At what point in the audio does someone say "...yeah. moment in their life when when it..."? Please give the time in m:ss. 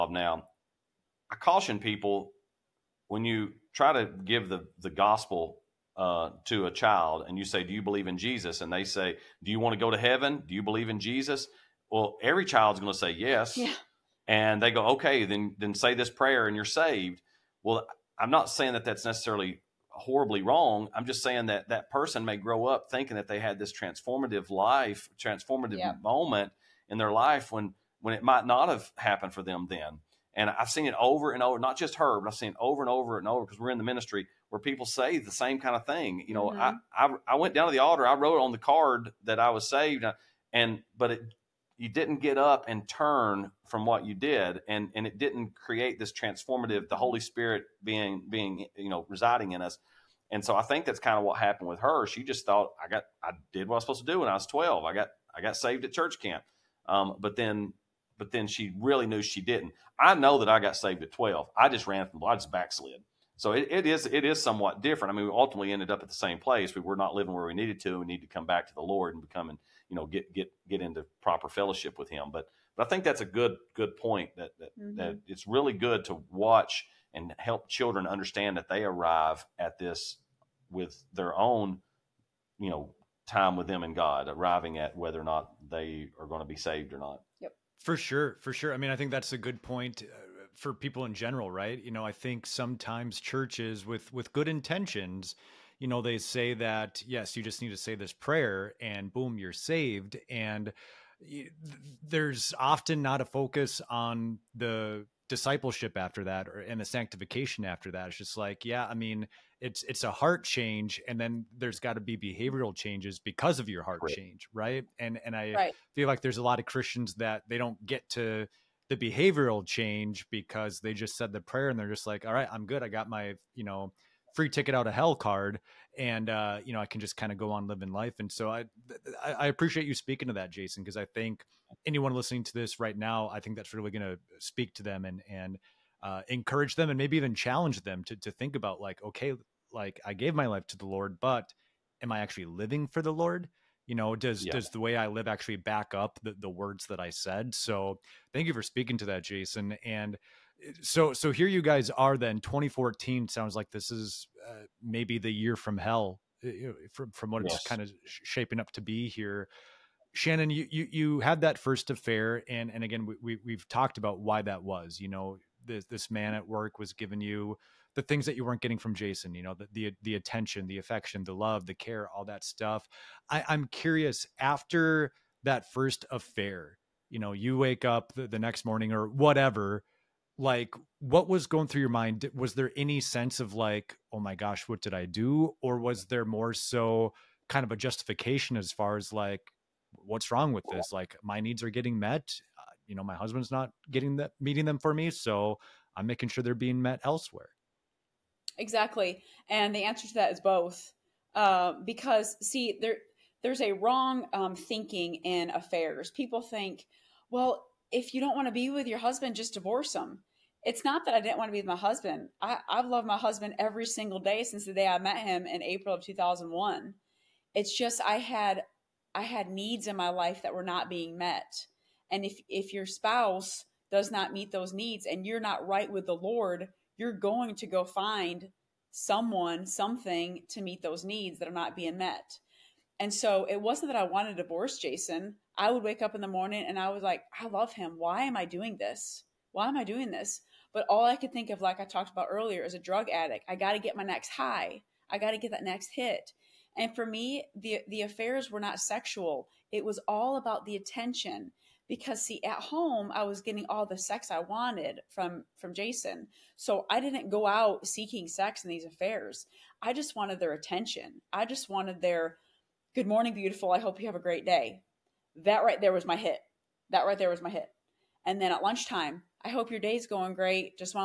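0:25.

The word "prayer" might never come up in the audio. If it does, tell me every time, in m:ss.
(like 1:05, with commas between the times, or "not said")
0:16, 1:38, 2:01.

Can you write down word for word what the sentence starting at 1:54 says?
change right and and i right.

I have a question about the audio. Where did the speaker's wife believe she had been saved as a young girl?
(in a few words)
church camp.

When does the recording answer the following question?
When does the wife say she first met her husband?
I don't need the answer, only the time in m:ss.
3:35.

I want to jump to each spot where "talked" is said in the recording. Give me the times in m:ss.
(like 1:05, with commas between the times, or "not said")
2:43, 4:01.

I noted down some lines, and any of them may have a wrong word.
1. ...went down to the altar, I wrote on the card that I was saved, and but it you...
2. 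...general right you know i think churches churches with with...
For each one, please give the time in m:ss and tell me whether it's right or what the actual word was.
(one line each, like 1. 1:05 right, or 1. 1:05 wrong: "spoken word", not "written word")
1. 0:37 right
2. 1:31 wrong: "sometimes", not "churches".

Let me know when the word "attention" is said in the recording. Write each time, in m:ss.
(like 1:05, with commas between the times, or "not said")
2:50, 4:10, 4:20.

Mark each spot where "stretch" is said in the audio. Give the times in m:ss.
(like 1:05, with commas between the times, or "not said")
not said.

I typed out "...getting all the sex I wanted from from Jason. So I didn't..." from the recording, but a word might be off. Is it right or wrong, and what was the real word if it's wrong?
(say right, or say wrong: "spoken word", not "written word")
right.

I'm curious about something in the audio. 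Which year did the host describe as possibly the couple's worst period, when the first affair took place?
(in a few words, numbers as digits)
2014.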